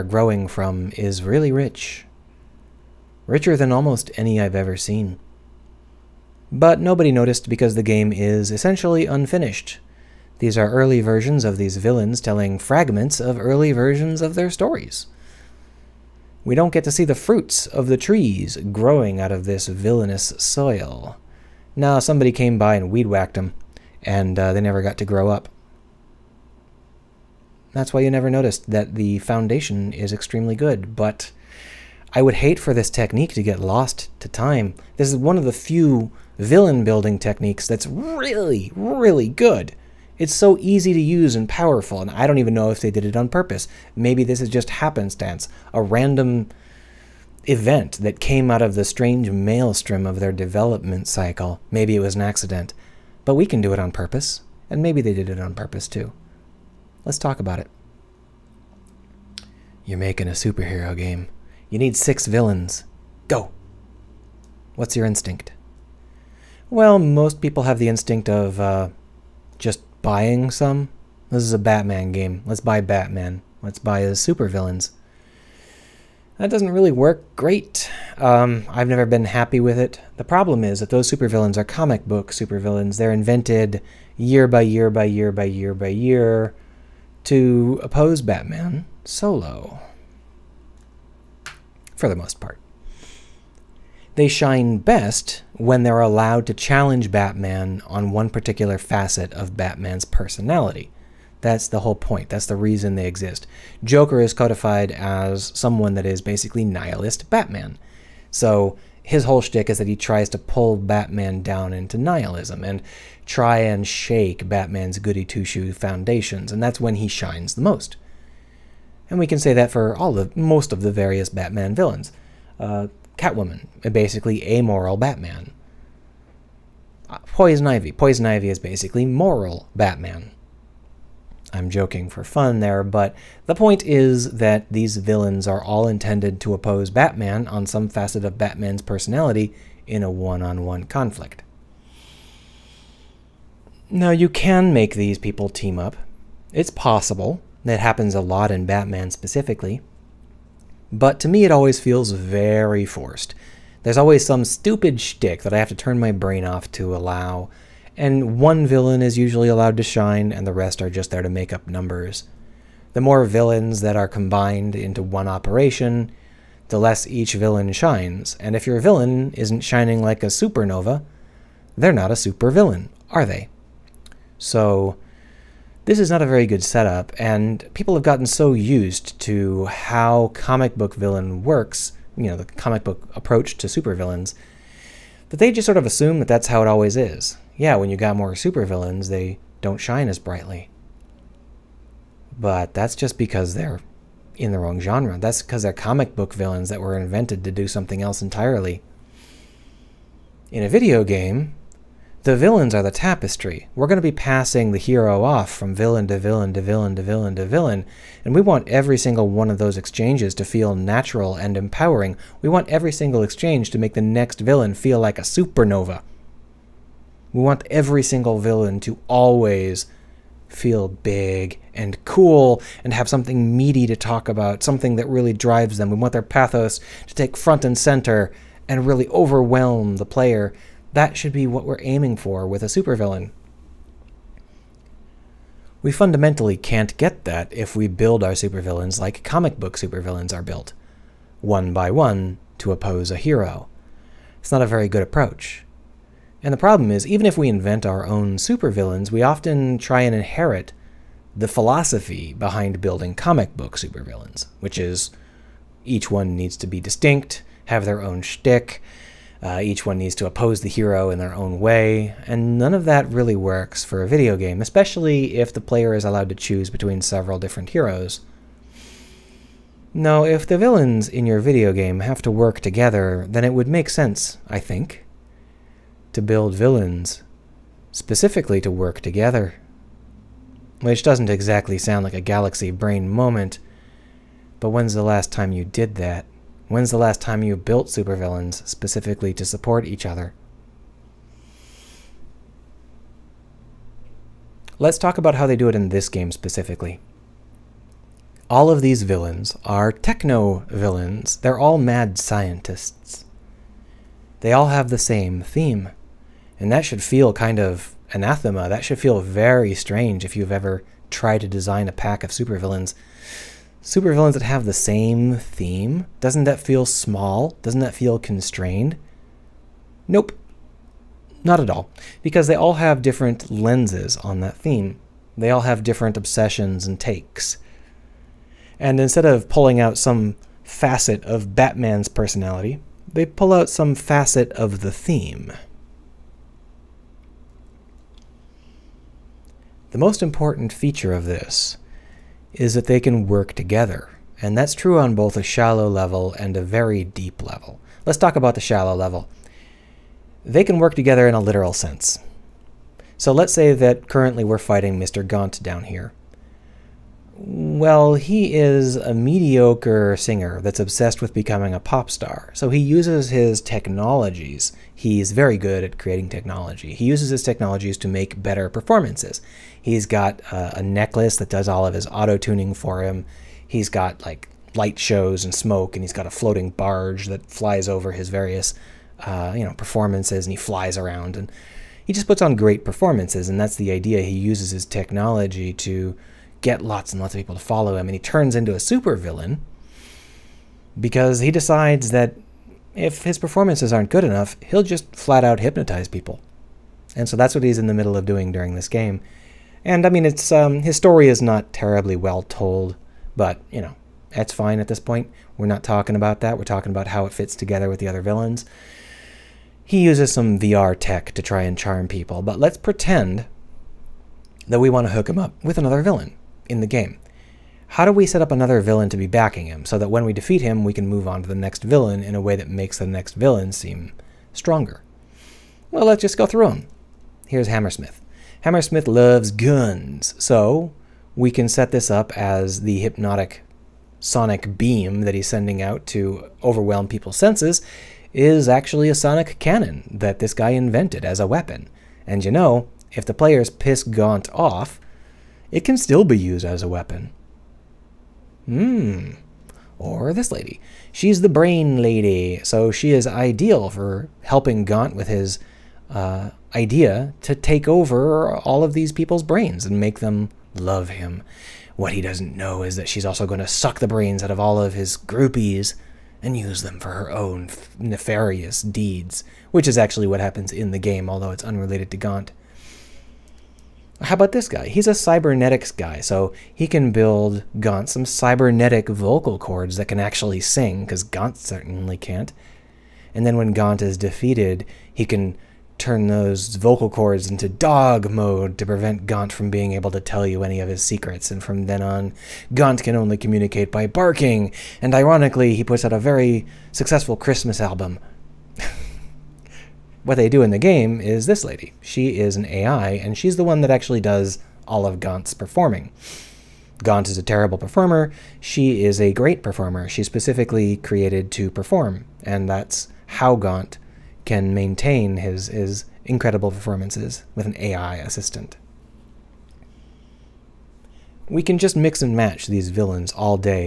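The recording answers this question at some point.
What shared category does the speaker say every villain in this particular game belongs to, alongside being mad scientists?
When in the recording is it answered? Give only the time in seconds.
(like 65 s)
299 s.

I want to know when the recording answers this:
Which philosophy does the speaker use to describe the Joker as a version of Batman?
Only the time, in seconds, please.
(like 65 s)
106 s.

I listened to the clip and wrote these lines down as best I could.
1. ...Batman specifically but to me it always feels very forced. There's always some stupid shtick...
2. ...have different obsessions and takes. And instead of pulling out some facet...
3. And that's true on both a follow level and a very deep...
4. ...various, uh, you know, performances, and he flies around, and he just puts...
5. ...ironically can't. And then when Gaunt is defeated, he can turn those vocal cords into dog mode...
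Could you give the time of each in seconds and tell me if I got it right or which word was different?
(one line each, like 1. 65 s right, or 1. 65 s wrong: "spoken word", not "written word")
1. 148 s right
2. 325 s right
3. 344 s wrong: "shallow", not "follow"
4. 378 s right
5. 481 s wrong: "certainly", not "ironically".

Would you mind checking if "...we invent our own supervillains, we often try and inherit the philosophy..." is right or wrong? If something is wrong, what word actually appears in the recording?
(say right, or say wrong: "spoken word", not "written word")
right.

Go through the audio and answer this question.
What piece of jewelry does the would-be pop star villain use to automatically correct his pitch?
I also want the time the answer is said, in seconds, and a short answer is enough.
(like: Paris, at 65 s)
A necklace, at 370 s.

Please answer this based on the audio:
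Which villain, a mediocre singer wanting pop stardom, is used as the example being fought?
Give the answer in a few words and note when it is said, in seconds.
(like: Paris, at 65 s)
Mr. Gaunt, at 354 s.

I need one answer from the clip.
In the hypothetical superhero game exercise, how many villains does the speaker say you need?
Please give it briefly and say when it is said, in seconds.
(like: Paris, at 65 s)
6, at 61 s.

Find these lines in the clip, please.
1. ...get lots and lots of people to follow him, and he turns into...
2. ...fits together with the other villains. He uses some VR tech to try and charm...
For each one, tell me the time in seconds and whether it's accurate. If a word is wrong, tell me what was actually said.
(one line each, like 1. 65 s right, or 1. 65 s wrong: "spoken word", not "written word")
1. 386 s right
2. 407 s right.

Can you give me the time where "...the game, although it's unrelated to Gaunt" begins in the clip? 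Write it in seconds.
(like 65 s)
470 s.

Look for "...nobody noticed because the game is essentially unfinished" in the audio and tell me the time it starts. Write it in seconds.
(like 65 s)
6 s.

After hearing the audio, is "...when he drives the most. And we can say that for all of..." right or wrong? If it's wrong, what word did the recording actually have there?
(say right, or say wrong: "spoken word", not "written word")
wrong: "shines", not "drives".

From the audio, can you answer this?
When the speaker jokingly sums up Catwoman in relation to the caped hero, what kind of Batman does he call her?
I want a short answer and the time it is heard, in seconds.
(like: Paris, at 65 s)
Amoral Batman, at 124 s.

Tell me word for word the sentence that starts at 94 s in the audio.
They shine best when they're allowed to challenge Batman on one particular facet of Batman's personality.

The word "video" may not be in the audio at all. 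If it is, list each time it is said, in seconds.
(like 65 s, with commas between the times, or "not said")
200 s, 264 s, 271 s.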